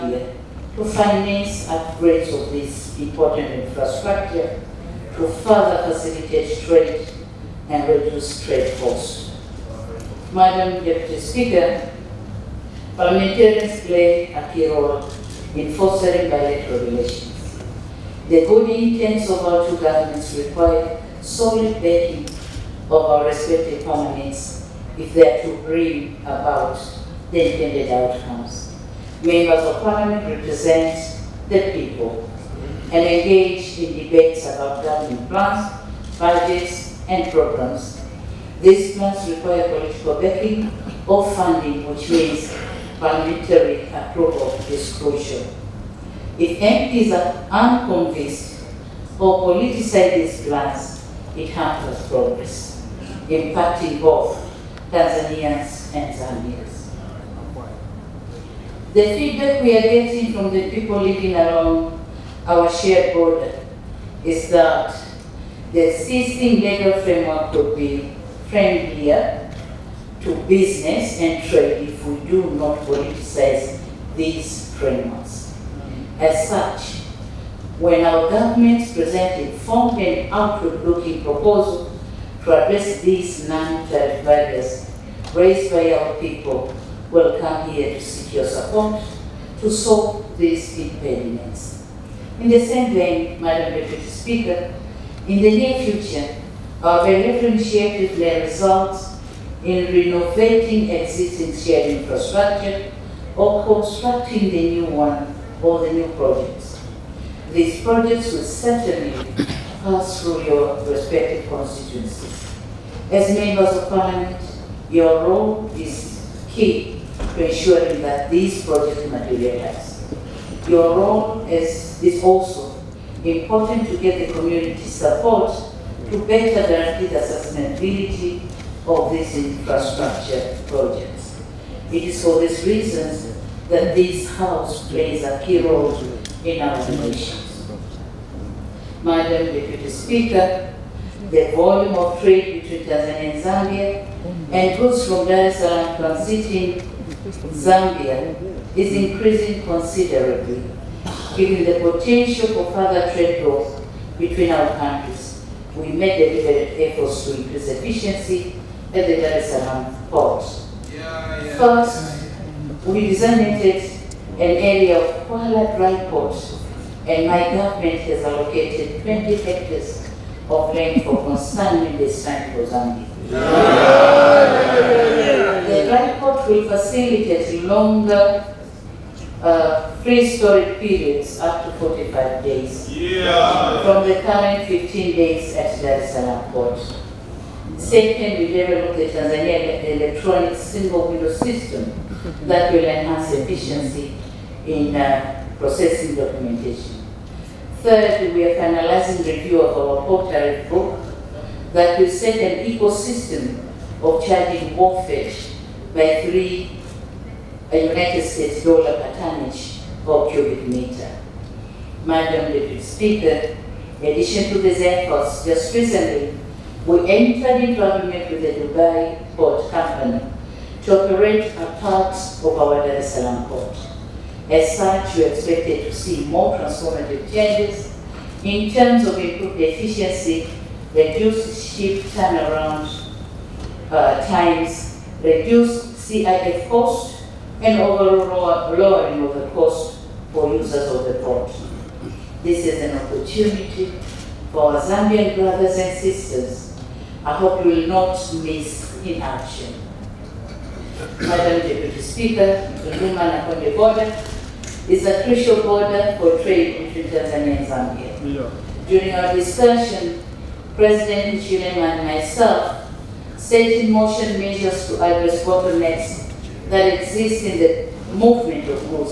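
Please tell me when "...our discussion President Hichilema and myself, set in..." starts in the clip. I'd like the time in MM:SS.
04:19.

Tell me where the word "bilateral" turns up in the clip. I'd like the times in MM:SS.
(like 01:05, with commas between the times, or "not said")
00:16, 01:36.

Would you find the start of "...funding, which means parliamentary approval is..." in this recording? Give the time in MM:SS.
00:41.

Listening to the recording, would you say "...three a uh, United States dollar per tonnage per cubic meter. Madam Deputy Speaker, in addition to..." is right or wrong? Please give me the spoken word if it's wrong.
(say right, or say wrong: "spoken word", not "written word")
right.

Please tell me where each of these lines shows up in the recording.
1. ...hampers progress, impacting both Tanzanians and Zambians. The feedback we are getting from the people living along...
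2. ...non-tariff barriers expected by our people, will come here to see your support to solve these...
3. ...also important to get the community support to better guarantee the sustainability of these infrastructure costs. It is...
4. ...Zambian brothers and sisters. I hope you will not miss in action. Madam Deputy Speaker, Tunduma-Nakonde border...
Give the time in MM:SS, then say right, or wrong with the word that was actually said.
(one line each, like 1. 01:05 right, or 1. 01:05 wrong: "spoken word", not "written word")
1. 00:51 right
2. 01:23 wrong: "raised", not "expected"
3. 02:02 wrong: "projects", not "costs"
4. 04:04 right.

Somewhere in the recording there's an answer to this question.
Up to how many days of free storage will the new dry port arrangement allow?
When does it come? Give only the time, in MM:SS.
03:01.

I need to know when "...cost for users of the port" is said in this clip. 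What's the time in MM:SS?
03:59.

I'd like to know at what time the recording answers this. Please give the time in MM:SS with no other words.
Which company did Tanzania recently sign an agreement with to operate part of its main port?
03:38.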